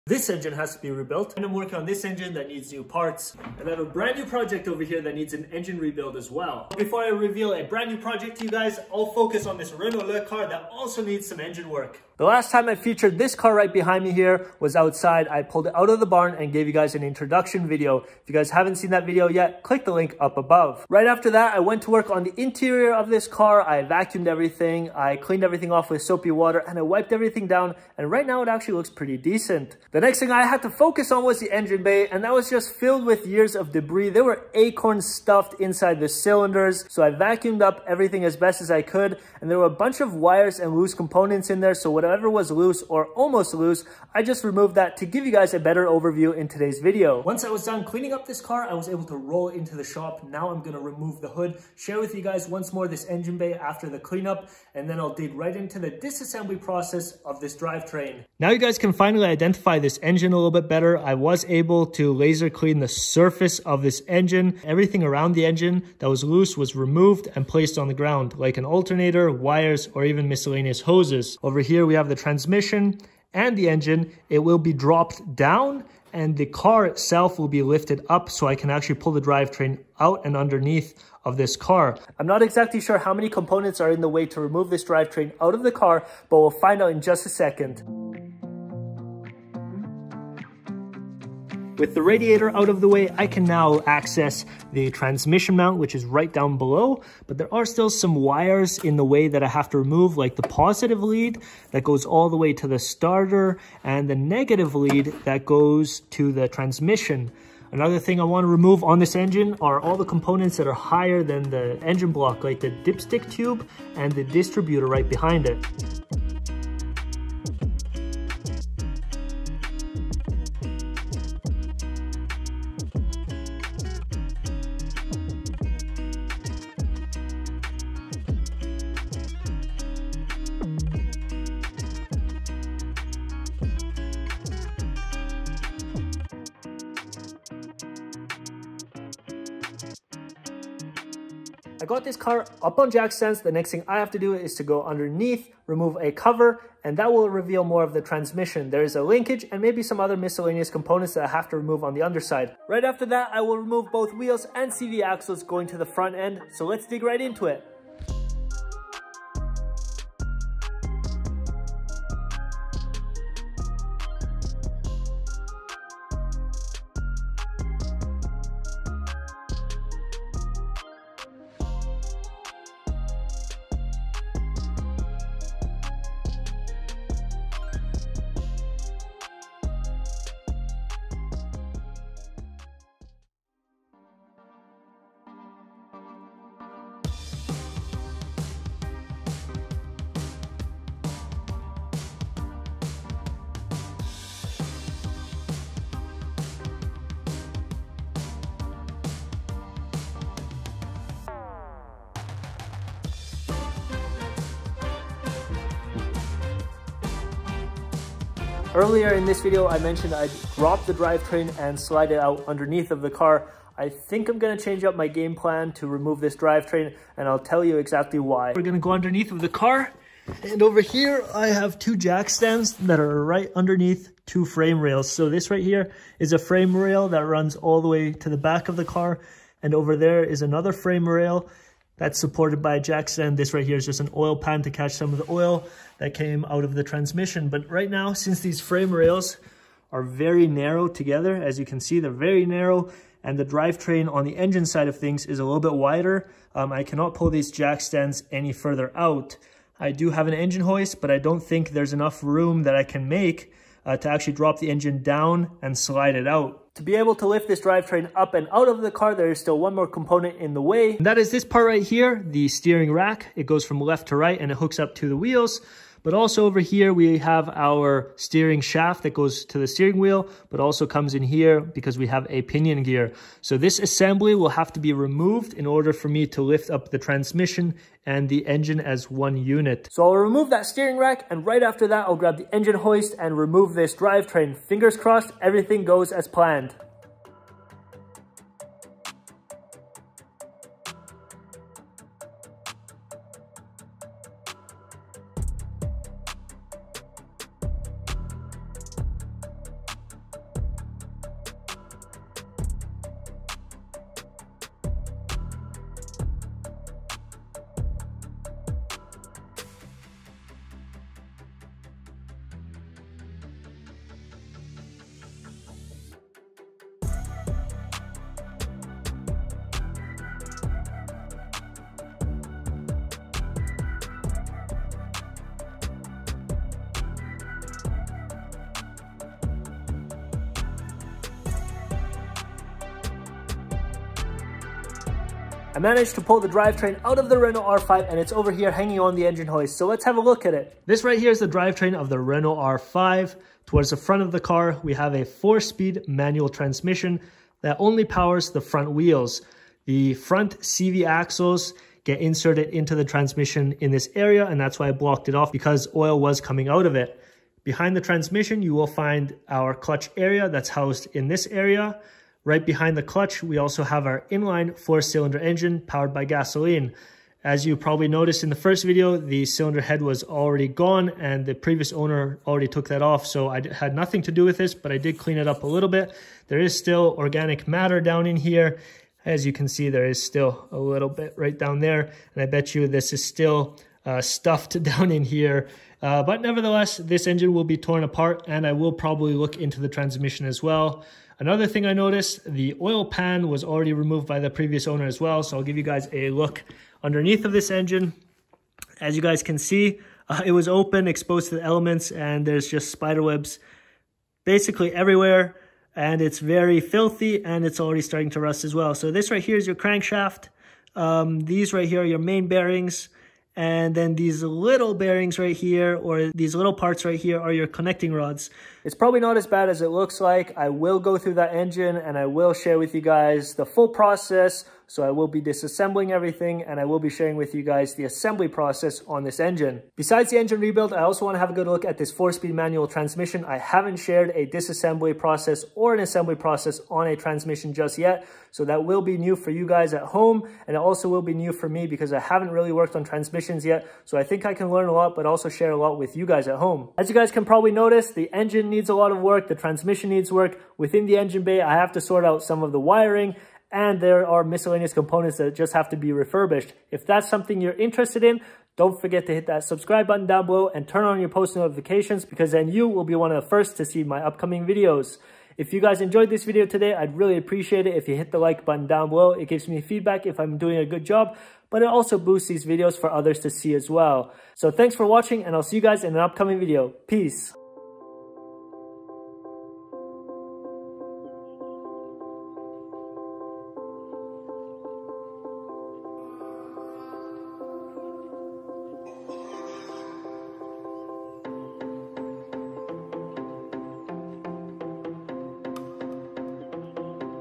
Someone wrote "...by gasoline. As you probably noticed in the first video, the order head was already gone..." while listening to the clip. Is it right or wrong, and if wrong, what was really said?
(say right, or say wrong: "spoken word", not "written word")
wrong: "cylinder", not "order".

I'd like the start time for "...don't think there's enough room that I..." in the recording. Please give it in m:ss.
4:11.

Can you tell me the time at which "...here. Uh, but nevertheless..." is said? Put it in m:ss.
6:25.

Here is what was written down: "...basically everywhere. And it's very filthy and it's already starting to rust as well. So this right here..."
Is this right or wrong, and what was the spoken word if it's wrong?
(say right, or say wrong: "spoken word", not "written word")
right.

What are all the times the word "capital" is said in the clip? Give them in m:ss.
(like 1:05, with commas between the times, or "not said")
not said.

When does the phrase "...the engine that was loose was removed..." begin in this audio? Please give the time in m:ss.
1:05.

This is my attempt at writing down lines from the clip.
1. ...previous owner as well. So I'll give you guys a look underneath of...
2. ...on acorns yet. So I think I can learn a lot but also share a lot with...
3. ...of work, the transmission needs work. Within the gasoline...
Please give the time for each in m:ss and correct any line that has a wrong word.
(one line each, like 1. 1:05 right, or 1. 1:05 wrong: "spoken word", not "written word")
1. 6:34 right
2. 7:22 wrong: "transmissions", not "acorns"
3. 7:29 wrong: "engine", not "gasoline".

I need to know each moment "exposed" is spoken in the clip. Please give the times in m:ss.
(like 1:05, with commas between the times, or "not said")
6:41.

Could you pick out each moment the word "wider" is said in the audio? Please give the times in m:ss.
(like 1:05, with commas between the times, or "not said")
4:05.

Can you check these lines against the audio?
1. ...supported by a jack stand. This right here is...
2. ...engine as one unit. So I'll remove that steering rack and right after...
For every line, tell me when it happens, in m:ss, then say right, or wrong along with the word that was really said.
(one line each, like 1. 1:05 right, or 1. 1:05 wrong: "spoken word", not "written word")
1. 3:52 right
2. 4:38 right.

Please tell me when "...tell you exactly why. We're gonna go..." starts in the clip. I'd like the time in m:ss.
3:37.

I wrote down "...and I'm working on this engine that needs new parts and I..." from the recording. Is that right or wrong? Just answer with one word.
right.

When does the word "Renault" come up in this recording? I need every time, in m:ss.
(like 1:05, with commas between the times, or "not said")
0:09, 5:37, 5:42.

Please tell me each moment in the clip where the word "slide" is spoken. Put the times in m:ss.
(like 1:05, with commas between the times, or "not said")
3:31, 4:15.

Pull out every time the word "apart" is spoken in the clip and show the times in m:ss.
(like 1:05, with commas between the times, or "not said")
6:28.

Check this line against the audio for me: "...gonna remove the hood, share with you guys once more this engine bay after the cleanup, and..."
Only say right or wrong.
right.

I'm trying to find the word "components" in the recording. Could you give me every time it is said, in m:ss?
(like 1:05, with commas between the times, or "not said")
0:40, 1:23, 1:50, 2:30, 4:19, 7:34.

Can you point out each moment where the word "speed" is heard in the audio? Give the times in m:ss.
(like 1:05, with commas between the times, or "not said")
5:45, 7:12.